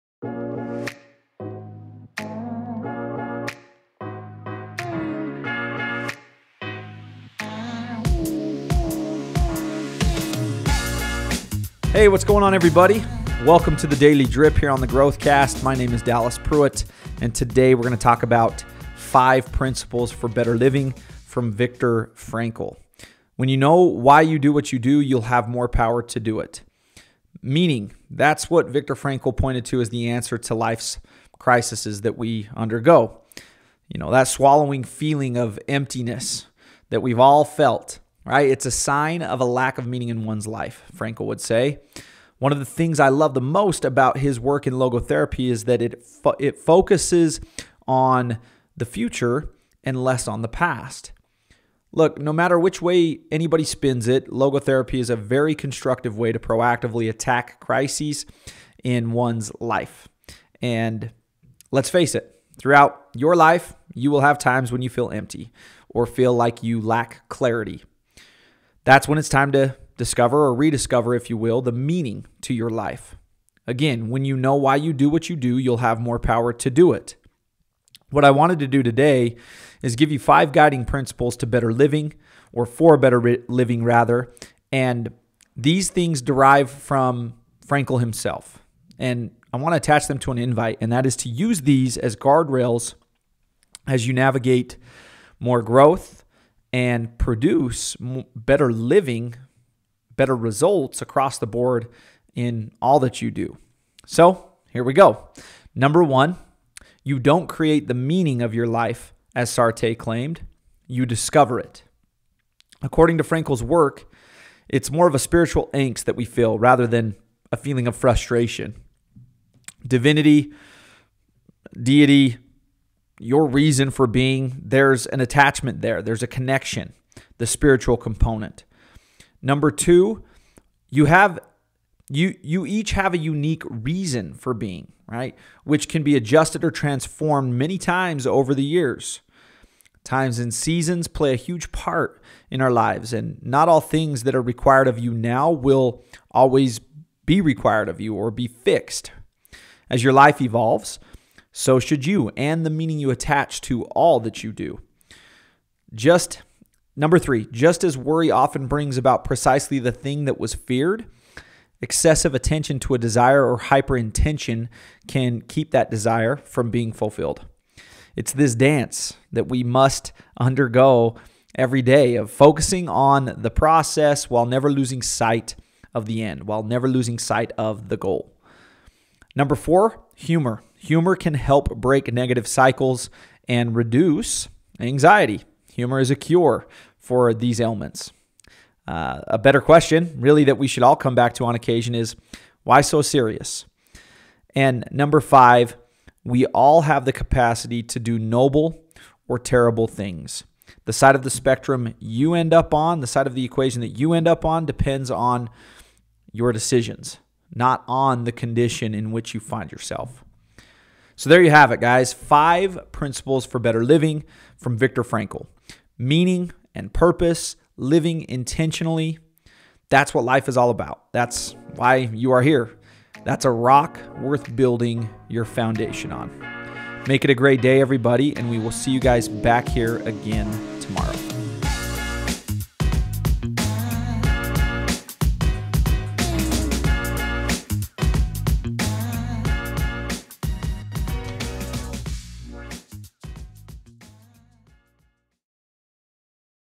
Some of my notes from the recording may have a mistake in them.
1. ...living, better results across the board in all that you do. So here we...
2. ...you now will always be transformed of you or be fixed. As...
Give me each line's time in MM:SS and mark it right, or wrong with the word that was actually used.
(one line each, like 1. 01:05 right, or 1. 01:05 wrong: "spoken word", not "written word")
1. 01:38 right
2. 02:24 wrong: "required", not "transformed".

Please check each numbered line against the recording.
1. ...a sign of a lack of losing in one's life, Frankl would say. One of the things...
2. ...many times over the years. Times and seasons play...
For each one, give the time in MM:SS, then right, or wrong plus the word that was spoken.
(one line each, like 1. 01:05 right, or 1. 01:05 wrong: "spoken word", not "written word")
1. 00:38 wrong: "meaning", not "losing"
2. 02:17 right.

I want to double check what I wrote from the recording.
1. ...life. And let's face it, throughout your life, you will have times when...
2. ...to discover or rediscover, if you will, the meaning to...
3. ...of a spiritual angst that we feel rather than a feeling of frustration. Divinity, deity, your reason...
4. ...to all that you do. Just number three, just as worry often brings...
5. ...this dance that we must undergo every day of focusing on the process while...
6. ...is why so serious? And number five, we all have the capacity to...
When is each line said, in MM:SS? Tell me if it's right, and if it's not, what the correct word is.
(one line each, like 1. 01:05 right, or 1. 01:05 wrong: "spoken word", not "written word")
1. 00:59 right
2. 01:09 right
3. 01:55 right
4. 02:33 right
5. 02:48 right
6. 03:11 right.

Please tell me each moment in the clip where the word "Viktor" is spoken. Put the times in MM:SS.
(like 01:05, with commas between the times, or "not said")
00:21, 00:28, 03:34.